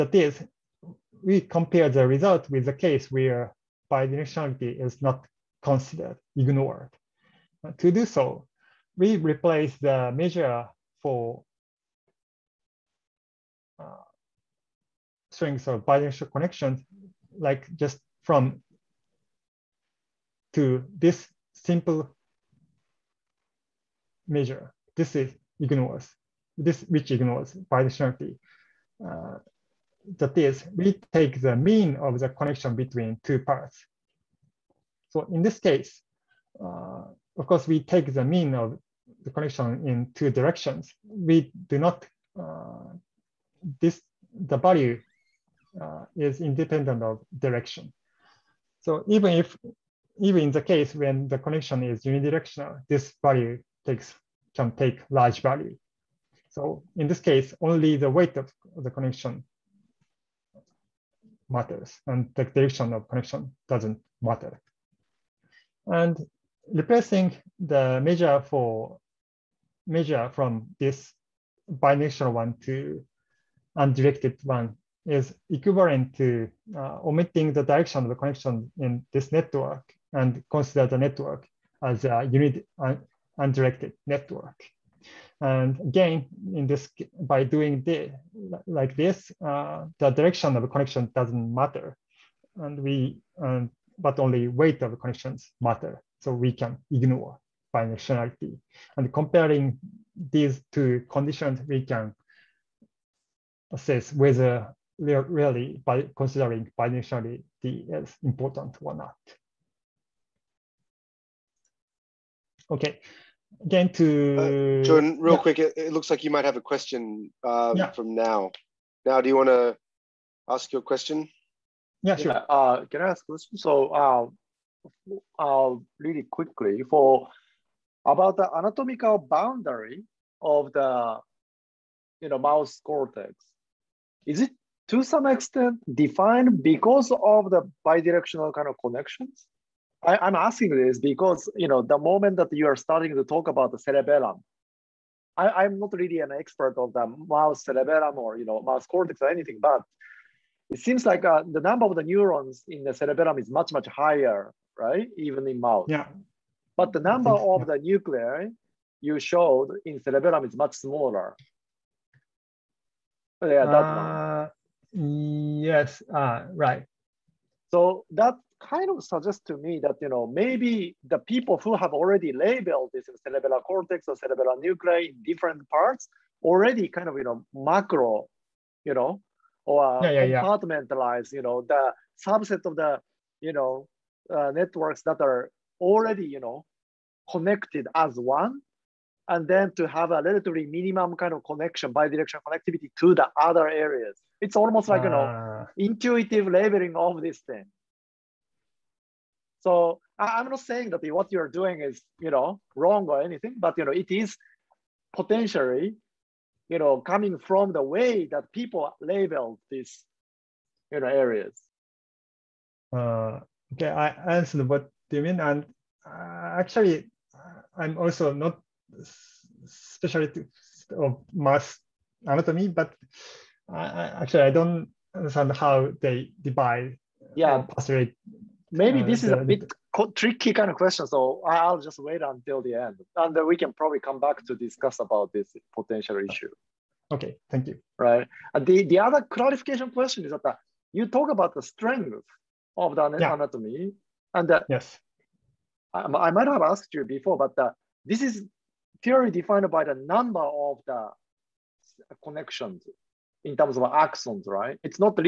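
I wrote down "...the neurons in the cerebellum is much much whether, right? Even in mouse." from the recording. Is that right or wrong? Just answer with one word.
wrong.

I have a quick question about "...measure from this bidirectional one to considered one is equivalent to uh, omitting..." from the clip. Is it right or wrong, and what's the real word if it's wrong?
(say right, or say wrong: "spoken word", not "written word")
wrong: "undirected", not "considered".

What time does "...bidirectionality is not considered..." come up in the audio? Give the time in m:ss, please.
0:03.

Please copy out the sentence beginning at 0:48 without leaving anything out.
So even if, even in the case when the connection is unidirectional, this value takes can take large value.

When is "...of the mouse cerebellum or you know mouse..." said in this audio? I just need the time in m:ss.
2:26.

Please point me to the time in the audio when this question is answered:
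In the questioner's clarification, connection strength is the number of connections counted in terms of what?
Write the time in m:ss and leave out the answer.
4:13.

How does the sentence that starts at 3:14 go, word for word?
It's almost like, uh, you know, ah.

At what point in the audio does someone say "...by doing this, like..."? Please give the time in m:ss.
1:27.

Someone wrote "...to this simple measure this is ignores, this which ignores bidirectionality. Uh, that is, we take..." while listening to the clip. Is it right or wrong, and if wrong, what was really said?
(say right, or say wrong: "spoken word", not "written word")
right.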